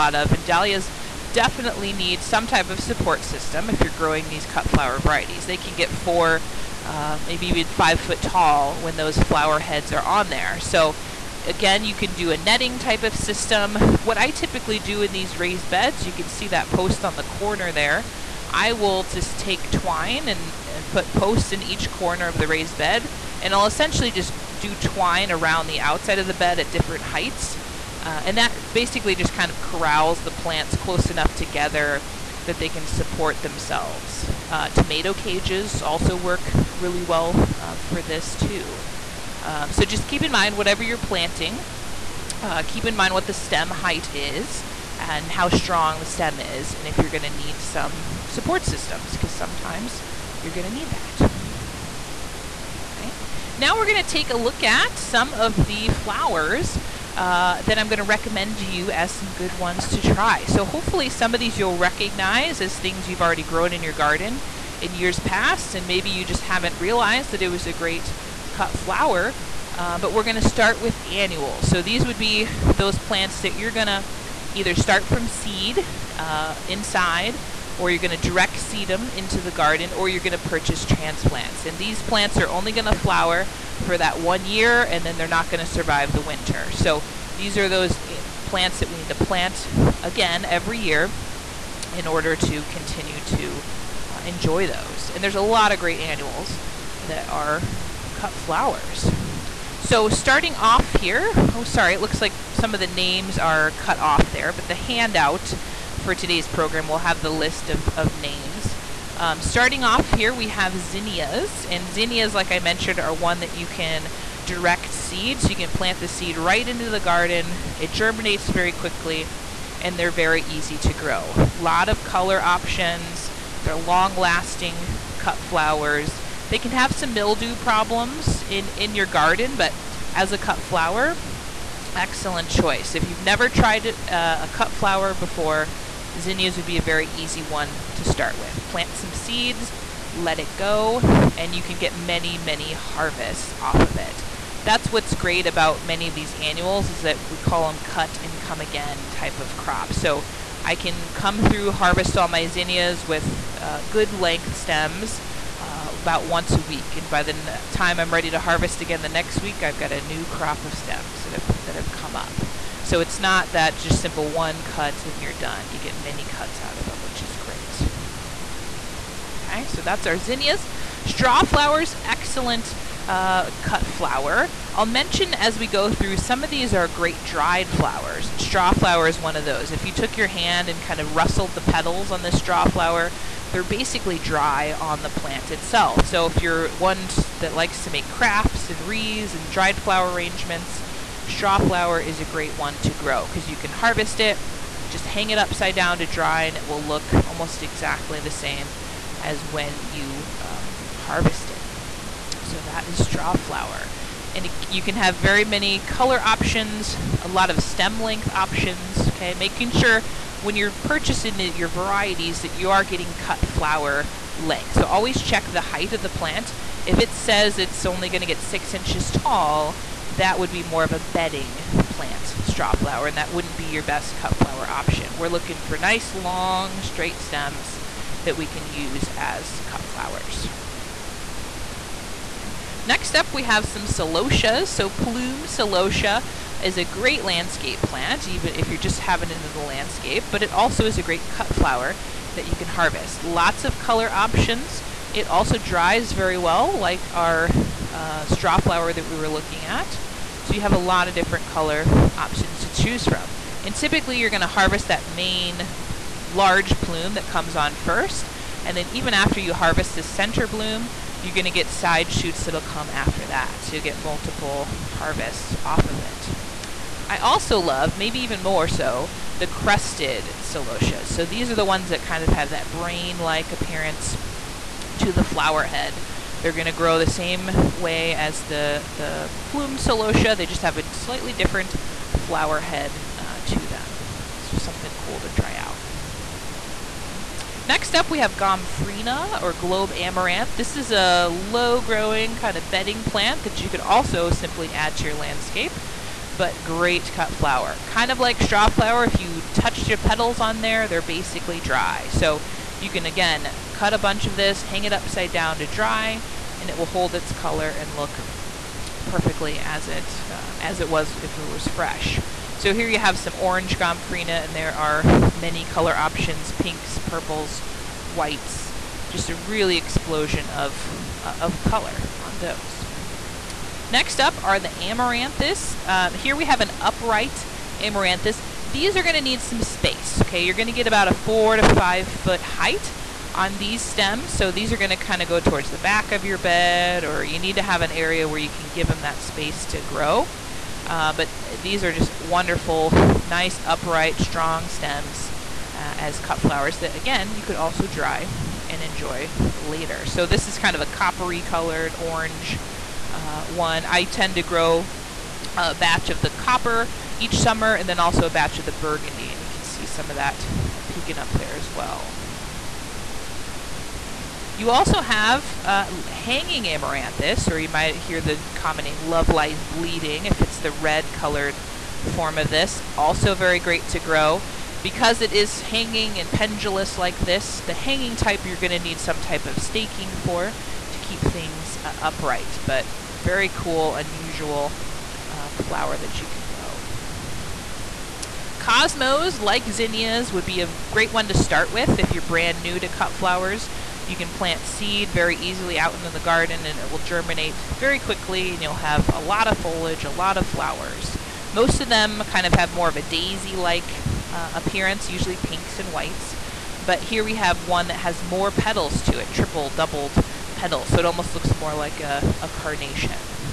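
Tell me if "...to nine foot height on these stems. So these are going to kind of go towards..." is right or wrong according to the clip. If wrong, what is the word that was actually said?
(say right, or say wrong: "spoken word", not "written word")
wrong: "five", not "nine".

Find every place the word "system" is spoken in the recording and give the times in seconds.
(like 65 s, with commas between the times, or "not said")
3 s, 13 s, 48 s.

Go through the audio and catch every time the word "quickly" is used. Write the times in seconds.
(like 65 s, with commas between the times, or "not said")
118 s, 397 s.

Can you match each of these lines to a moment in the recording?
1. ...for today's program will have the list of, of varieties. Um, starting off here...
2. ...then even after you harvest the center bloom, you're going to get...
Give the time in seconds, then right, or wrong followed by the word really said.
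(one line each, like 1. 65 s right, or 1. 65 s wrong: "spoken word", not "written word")
1. 105 s wrong: "names", not "varieties"
2. 258 s right.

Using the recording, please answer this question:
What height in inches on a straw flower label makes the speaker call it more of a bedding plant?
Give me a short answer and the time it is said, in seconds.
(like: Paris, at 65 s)
6, at 218 s.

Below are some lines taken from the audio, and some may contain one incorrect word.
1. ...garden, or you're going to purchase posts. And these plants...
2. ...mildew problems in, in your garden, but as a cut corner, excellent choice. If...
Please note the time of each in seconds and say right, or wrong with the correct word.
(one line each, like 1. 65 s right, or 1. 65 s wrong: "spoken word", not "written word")
1. 79 s wrong: "transplants", not "posts"
2. 127 s wrong: "flower", not "corner".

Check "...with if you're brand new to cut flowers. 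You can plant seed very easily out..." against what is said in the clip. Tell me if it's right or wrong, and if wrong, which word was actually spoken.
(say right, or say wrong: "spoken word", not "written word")
right.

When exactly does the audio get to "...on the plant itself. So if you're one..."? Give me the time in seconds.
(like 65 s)
184 s.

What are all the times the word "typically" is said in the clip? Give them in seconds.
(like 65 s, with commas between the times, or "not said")
14 s, 253 s.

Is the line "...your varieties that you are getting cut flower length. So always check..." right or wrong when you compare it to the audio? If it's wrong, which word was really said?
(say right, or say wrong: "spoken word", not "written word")
right.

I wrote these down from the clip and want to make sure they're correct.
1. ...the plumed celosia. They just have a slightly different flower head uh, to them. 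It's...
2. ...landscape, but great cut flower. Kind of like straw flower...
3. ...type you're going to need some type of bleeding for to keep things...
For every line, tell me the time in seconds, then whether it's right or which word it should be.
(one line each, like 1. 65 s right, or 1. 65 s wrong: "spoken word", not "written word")
1. 278 s right
2. 295 s right
3. 378 s wrong: "staking", not "bleeding".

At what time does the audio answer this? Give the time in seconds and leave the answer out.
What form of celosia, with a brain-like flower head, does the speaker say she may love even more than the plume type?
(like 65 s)
269 s.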